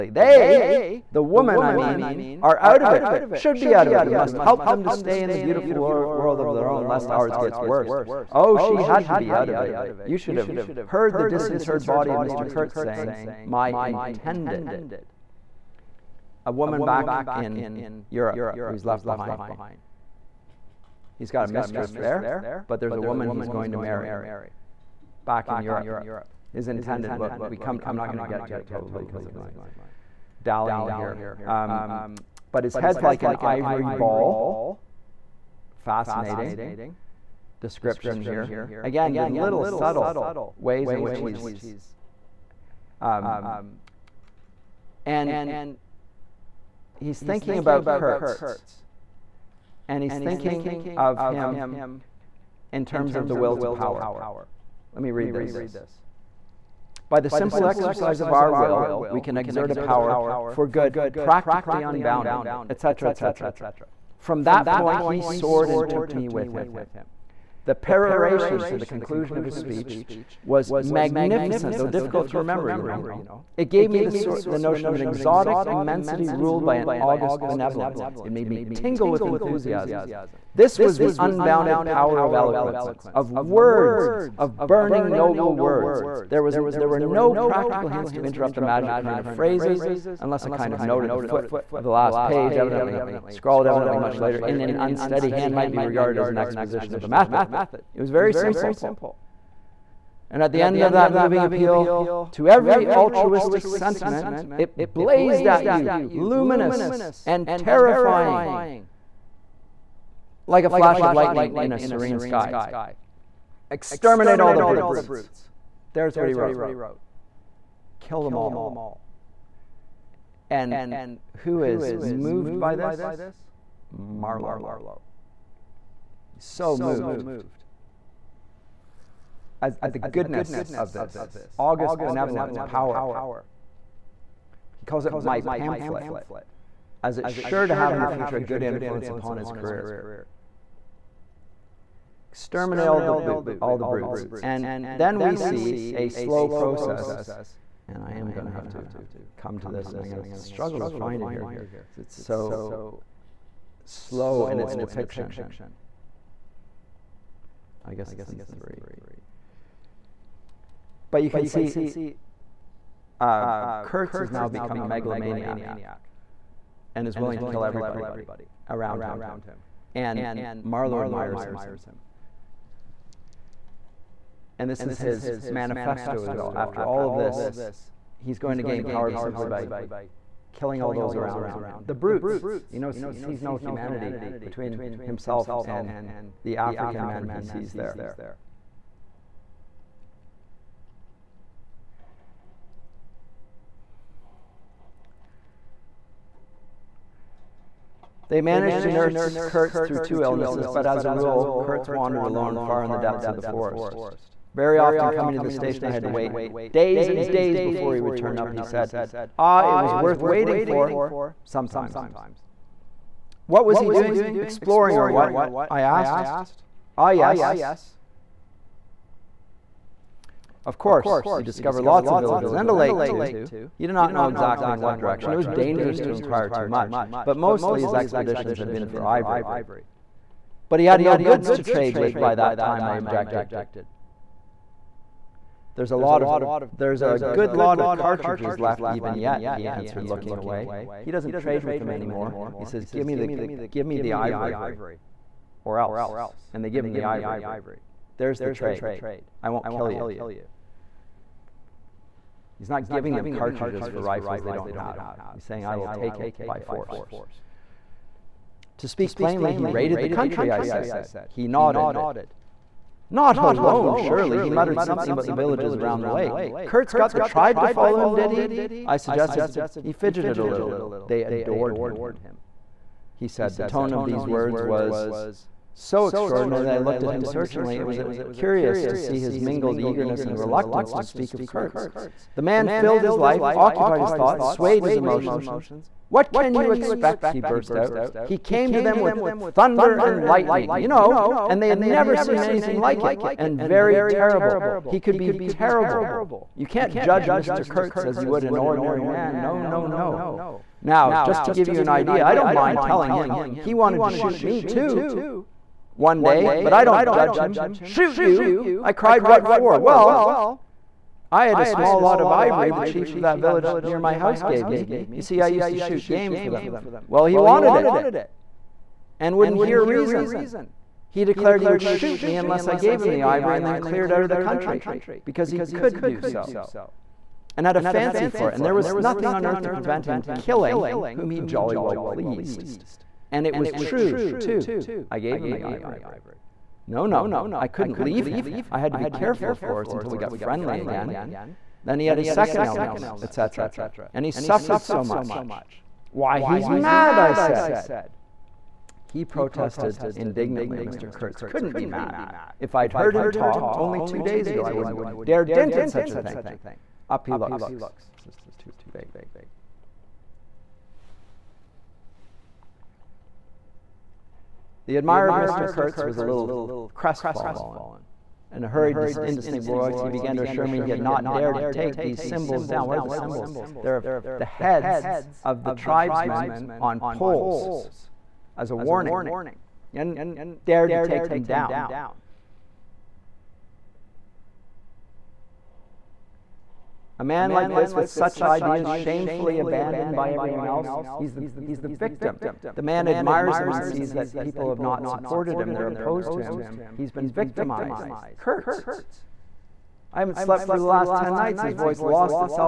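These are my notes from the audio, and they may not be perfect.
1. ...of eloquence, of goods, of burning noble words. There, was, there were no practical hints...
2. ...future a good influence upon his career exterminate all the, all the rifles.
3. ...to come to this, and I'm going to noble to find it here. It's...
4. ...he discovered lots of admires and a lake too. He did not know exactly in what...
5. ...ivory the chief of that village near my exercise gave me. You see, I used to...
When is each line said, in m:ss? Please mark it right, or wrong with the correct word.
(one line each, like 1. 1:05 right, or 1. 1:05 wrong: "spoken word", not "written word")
1. 1:22 wrong: "words", not "goods"
2. 2:18 wrong: "brutes", not "rifles"
3. 2:28 wrong: "struggle", not "noble"
4. 3:41 wrong: "villages", not "admires"
5. 5:12 wrong: "house", not "exercise".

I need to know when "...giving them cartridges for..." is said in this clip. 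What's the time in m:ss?
4:12.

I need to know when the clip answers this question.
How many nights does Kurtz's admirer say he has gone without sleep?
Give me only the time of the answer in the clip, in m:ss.
6:41.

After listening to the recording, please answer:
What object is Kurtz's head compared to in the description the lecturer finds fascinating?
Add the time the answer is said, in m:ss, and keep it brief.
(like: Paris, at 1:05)
An ivory ball, at 0:33.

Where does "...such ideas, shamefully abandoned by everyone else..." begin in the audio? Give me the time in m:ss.
6:28.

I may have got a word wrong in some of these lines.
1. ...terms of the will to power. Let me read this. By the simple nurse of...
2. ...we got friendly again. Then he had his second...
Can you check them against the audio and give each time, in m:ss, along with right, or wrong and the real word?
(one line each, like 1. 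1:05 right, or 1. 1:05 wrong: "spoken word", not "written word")
1. 0:52 wrong: "exercise", not "nurse"
2. 5:40 right.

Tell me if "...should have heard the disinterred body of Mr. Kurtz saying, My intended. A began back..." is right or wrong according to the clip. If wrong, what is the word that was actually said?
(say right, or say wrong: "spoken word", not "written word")
wrong: "woman", not "began".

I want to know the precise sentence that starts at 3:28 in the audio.
He said, Ah, it was worth waiting for, sometimes.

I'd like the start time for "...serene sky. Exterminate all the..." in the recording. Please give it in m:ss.
1:51.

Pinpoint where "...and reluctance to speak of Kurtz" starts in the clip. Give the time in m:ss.
4:40.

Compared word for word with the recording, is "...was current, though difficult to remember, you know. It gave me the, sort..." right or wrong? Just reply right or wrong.
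wrong.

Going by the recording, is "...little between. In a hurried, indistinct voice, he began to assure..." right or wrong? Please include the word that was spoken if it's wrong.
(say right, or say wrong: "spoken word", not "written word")
wrong: "crestfallen", not "between".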